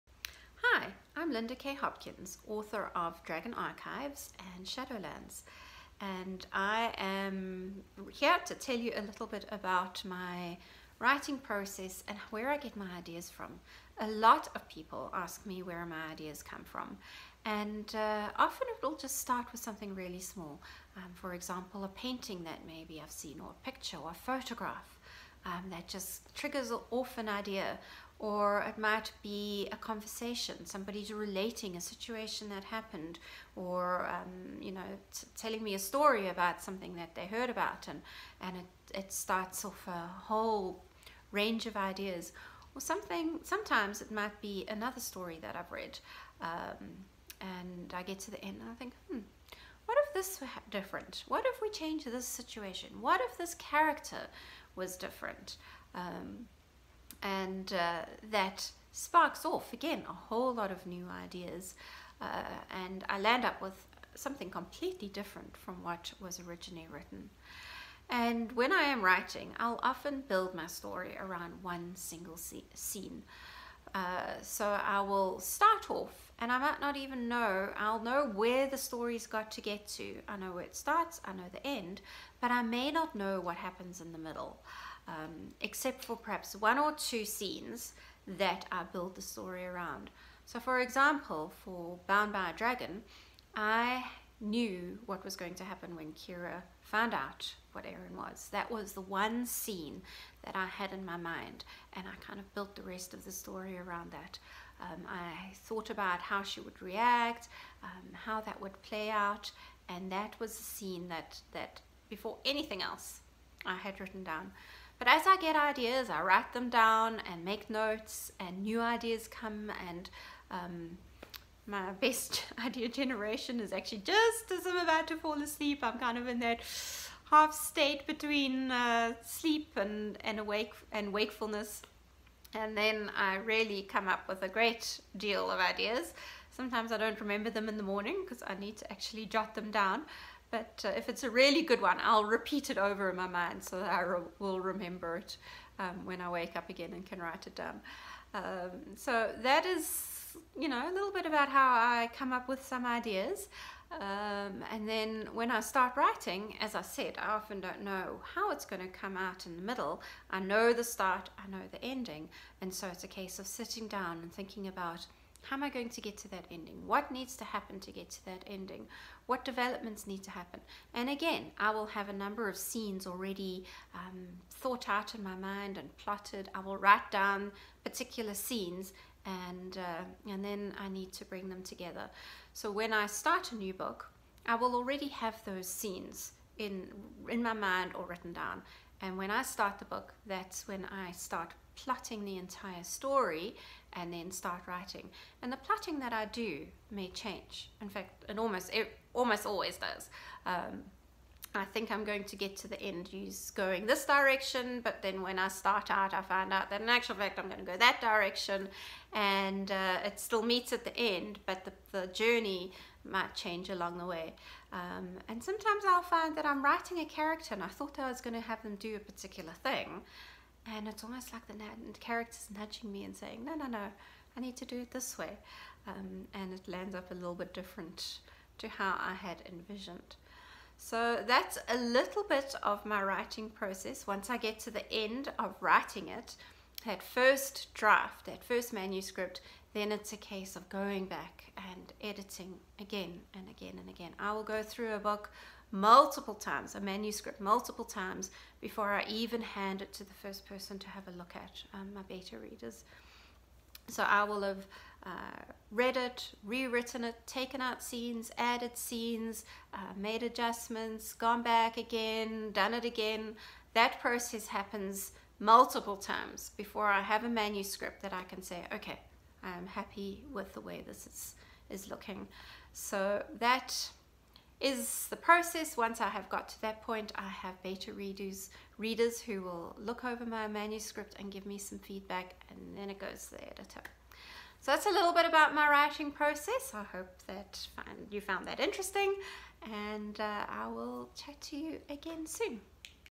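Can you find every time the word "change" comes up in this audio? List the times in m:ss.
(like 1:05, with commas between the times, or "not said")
0:51, 3:17, 3:33.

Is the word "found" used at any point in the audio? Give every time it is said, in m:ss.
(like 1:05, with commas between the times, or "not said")
1:36, 4:48.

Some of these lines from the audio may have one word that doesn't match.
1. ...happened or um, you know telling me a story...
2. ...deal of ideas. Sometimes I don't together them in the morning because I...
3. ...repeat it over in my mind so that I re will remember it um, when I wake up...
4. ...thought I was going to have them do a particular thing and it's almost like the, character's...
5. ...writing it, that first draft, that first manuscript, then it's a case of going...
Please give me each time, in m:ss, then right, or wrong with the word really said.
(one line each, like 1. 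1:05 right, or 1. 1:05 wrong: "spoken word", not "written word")
1. 0:32 right
2. 2:15 wrong: "remember", not "together"
3. 2:22 right
4. 3:37 right
5. 3:55 right.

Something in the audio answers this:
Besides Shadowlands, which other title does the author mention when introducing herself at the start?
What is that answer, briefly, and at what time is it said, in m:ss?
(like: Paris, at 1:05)
Dragon Archives, at 0:03.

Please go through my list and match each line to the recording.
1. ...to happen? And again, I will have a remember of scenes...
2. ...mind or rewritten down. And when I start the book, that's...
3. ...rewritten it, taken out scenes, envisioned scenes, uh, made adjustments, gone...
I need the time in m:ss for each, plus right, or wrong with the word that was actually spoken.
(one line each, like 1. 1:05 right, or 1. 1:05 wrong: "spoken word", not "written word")
1. 2:50 wrong: "number", not "remember"
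2. 3:07 wrong: "written", not "rewritten"
3. 4:16 wrong: "added", not "envisioned".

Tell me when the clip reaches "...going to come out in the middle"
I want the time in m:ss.
2:38.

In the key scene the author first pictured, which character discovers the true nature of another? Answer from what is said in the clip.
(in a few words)
Kira.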